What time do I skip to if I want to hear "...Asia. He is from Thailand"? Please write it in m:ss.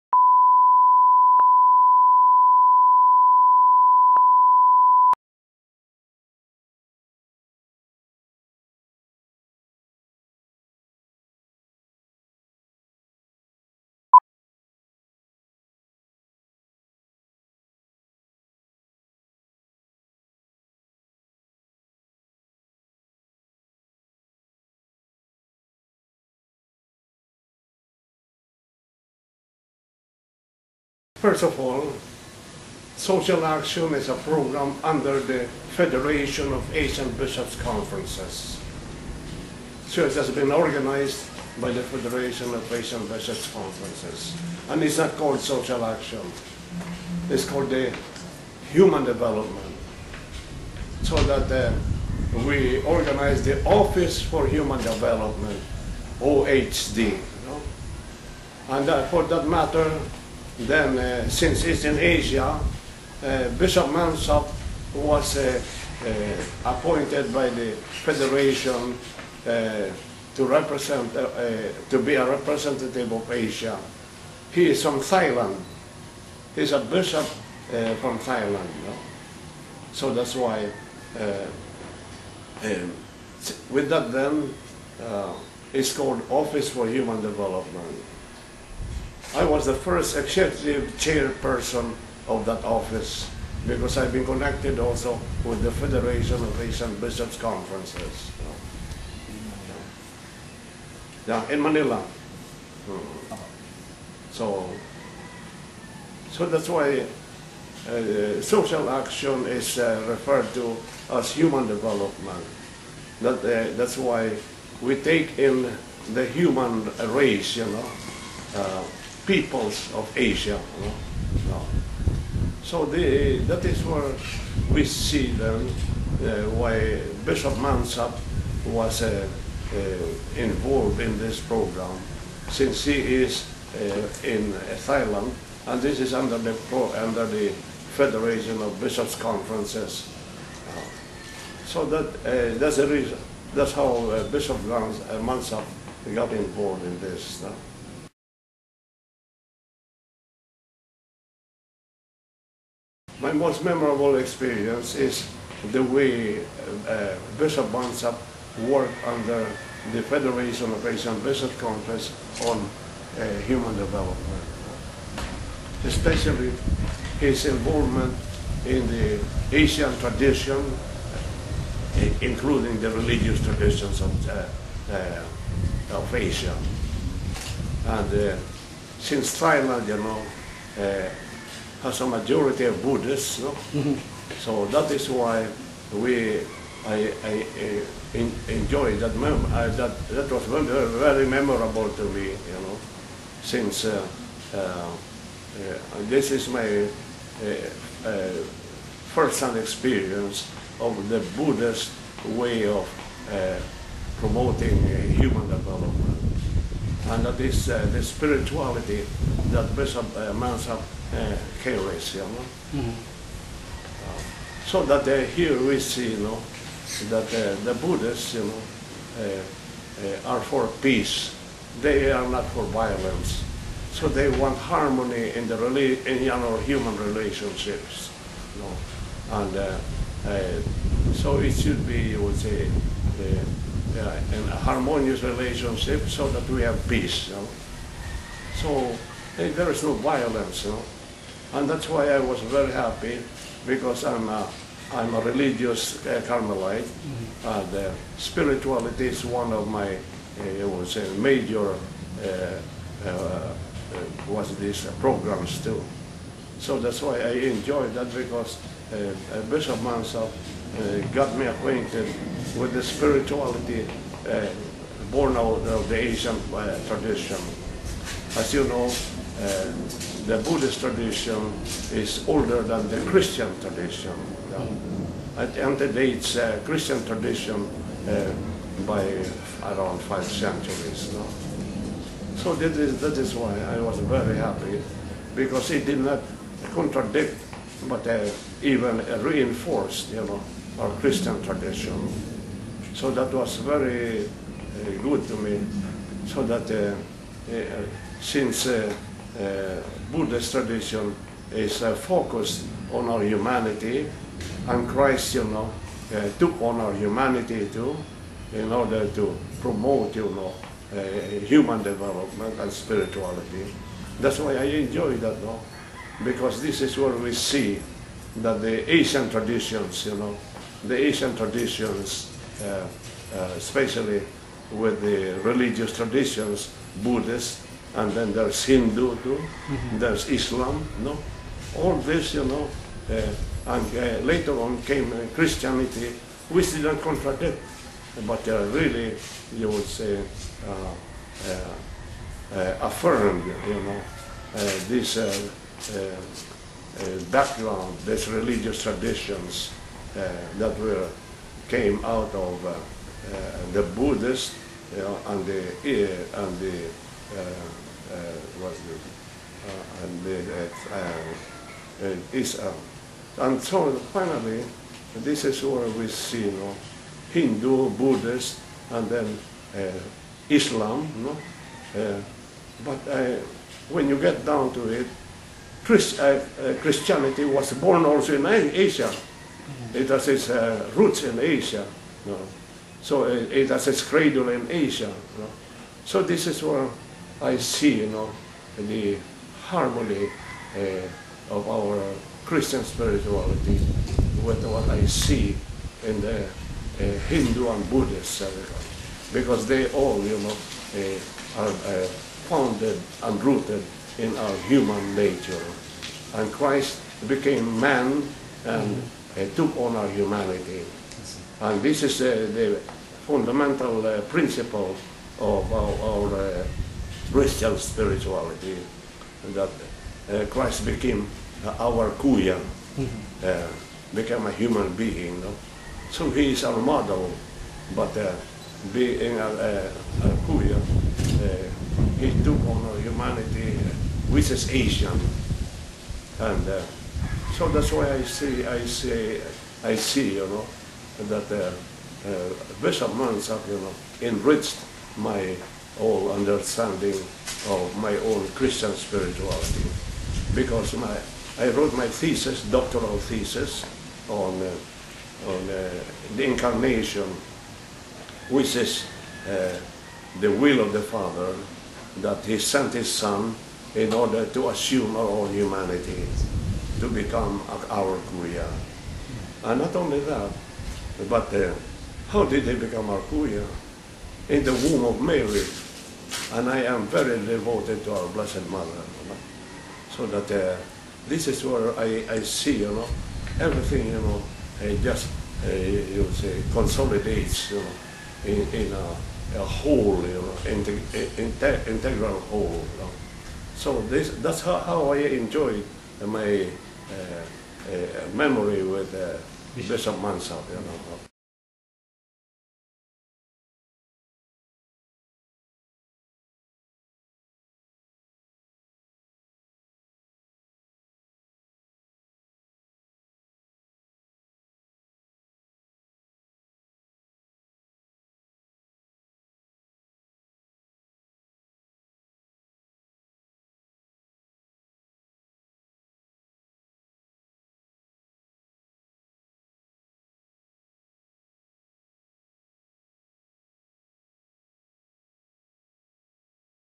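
1:13.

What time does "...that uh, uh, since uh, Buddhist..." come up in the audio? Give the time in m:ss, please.
4:56.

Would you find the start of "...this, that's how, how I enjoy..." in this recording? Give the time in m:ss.
8:14.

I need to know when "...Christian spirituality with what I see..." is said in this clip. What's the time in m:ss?
6:32.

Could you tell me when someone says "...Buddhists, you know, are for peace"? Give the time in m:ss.
3:37.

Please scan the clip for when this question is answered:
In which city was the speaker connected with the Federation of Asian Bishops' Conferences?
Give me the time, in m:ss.
1:41.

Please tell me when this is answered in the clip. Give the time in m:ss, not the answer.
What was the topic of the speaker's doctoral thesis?
7:36.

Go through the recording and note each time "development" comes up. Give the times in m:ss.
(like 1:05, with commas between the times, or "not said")
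0:49, 0:54, 1:27, 1:51, 2:43, 3:25, 5:11.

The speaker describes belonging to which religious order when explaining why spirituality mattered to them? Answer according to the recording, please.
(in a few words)
Carmelite.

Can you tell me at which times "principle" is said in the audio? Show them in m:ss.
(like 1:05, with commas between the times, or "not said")
6:54.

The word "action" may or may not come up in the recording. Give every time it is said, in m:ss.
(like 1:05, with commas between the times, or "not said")
0:33, 0:45, 1:48.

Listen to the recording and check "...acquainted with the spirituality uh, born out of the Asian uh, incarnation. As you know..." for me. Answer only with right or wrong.
wrong.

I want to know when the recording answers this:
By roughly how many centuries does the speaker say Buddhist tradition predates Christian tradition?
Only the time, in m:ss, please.
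4:40.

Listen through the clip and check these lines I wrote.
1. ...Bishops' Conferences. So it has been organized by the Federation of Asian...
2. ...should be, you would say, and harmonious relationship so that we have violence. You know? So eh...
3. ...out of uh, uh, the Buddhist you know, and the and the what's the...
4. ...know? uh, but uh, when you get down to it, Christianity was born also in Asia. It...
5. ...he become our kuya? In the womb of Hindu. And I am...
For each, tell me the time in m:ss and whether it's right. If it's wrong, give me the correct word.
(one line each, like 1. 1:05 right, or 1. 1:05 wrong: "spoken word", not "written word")
1. 0:37 right
2. 3:51 wrong: "peace", not "violence"
3. 5:52 right
4. 6:11 right
5. 7:52 wrong: "Mary", not "Hindu".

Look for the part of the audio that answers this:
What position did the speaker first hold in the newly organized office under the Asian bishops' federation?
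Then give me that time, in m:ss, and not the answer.
1:30.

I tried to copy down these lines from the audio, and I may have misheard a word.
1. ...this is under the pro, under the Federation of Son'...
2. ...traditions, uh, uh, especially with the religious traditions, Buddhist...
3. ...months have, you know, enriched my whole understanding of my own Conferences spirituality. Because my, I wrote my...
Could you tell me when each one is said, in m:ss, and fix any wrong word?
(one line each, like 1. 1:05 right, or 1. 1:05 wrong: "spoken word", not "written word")
1. 2:15 wrong: "Bishops", not "Son"
2. 5:21 right
3. 7:23 wrong: "Christian", not "Conferences".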